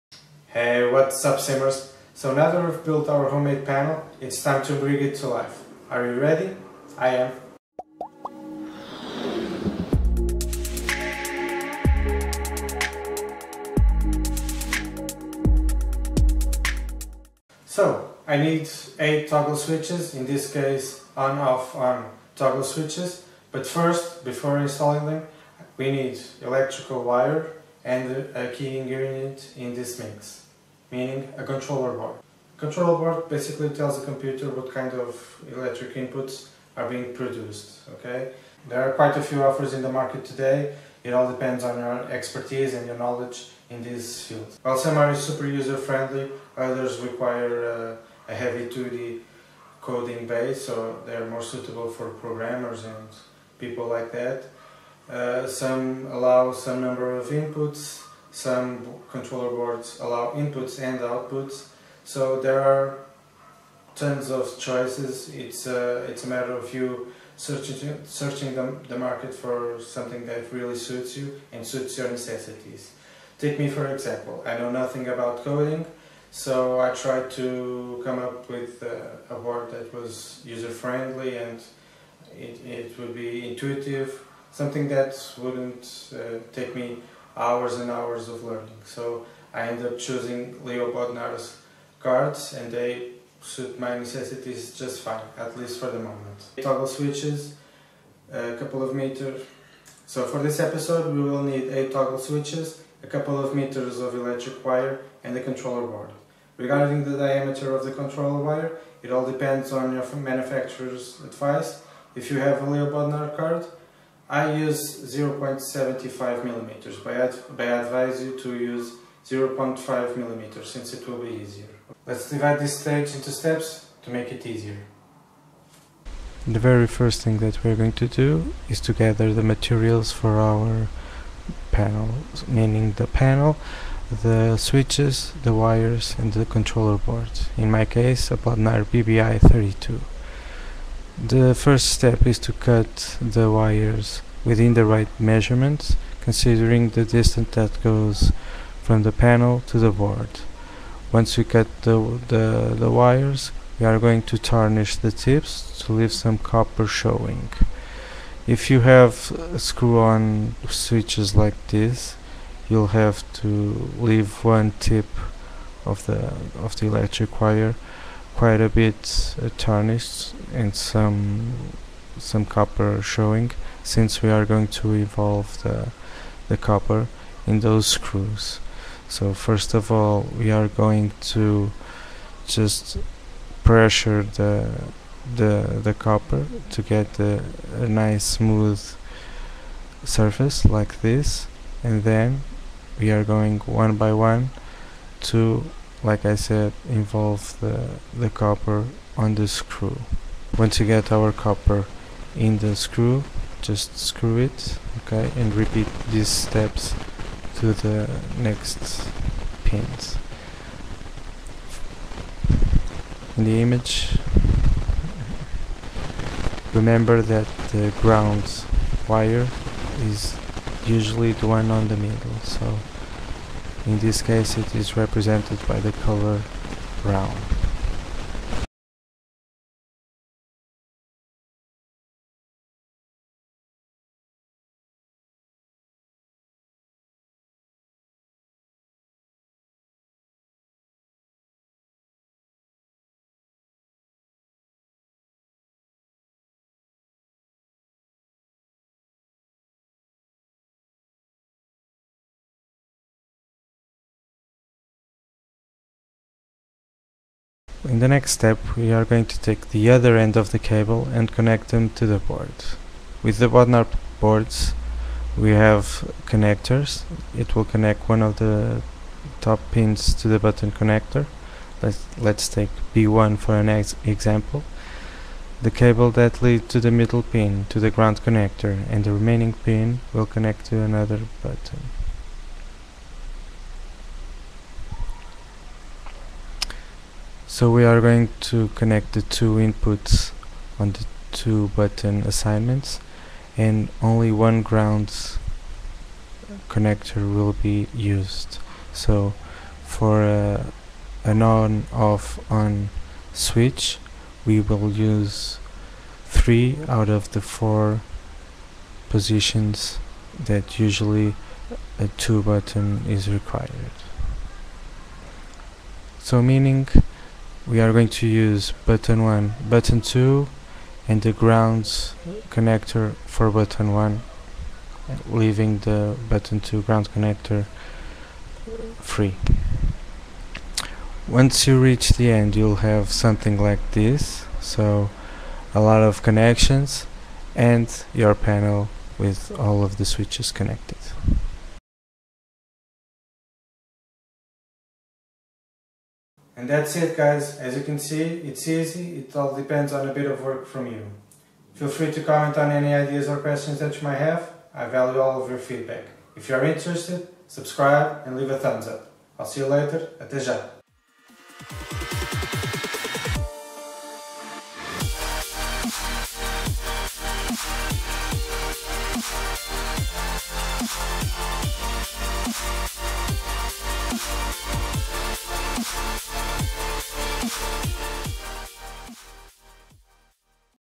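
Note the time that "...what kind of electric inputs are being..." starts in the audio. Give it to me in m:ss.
0:34.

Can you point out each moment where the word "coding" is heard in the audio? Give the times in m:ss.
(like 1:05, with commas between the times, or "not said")
0:49, 1:15.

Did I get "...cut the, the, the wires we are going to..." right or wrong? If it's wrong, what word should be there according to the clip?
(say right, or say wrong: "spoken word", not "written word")
right.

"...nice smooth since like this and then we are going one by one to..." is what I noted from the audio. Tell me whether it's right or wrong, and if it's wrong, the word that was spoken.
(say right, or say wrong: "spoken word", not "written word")
wrong: "surface", not "since".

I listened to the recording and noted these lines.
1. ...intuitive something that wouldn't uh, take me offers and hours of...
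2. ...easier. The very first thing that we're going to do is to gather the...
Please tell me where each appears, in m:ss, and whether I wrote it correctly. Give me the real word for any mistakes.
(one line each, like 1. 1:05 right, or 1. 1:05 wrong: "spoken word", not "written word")
1. 1:23 wrong: "hours", not "offers"
2. 2:04 right.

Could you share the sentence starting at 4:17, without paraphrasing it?
In the next step we are going to take the other end of the cable and connect them to the board.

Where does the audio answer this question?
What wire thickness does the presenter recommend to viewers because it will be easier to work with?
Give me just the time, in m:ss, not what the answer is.
1:59.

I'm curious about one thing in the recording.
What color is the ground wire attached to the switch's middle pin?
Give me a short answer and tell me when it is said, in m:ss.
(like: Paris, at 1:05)
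brown, at 3:47.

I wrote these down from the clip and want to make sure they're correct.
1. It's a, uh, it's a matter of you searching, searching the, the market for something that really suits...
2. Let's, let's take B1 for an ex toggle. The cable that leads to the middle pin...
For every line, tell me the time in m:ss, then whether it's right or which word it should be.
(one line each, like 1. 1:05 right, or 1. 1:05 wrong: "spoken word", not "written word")
1. 1:05 right
2. 4:31 wrong: "example", not "toggle".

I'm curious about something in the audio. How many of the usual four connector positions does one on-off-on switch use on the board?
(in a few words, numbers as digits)
3.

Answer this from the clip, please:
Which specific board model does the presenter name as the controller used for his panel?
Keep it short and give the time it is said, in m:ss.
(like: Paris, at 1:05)
Platinum BBI32, at 2:18.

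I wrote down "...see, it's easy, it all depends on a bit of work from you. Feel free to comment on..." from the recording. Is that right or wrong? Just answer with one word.
right.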